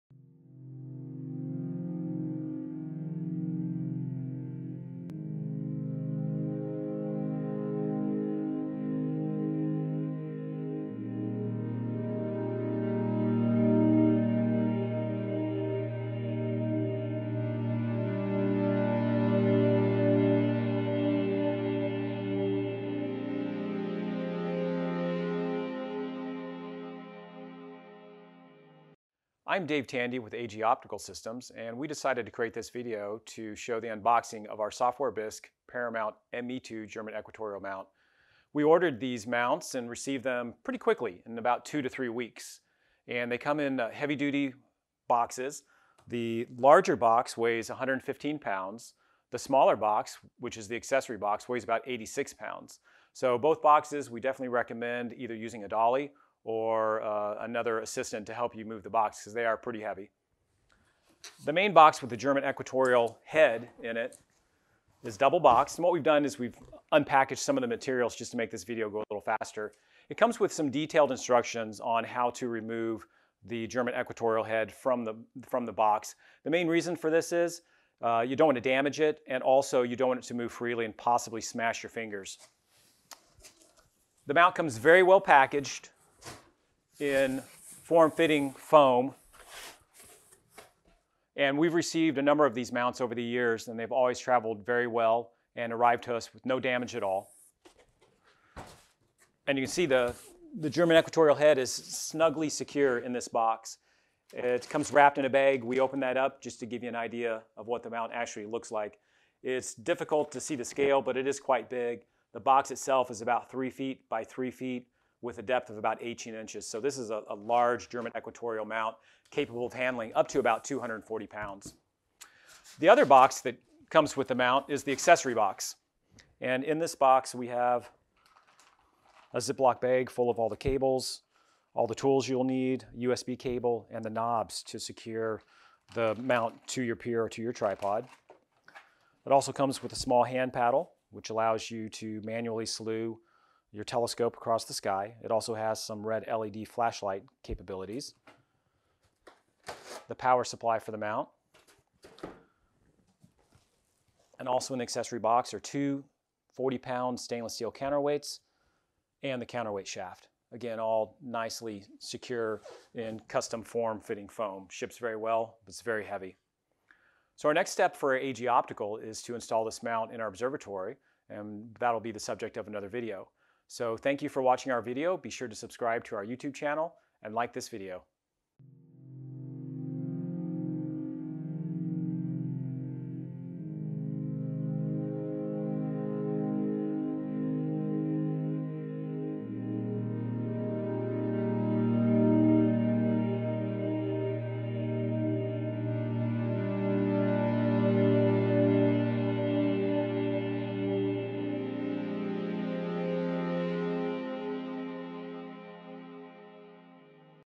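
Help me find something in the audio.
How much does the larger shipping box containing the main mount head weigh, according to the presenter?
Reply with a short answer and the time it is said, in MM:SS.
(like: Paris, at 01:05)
115 pounds, at 00:47.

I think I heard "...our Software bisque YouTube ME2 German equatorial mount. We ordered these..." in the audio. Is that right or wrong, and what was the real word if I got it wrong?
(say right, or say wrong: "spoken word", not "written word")
wrong: "Paramount", not "YouTube".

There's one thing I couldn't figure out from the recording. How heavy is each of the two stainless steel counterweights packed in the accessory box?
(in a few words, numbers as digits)
40 pounds.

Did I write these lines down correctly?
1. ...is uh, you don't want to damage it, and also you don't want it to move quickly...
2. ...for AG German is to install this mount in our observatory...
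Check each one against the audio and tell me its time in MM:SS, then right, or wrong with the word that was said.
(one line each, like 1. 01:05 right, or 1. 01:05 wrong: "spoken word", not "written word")
1. 01:17 wrong: "freely", not "quickly"
2. 02:47 wrong: "Optical", not "German".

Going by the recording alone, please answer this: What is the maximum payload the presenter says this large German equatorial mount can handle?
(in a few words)
240 pounds.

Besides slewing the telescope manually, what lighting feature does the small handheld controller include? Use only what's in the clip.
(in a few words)
red LED flashlight.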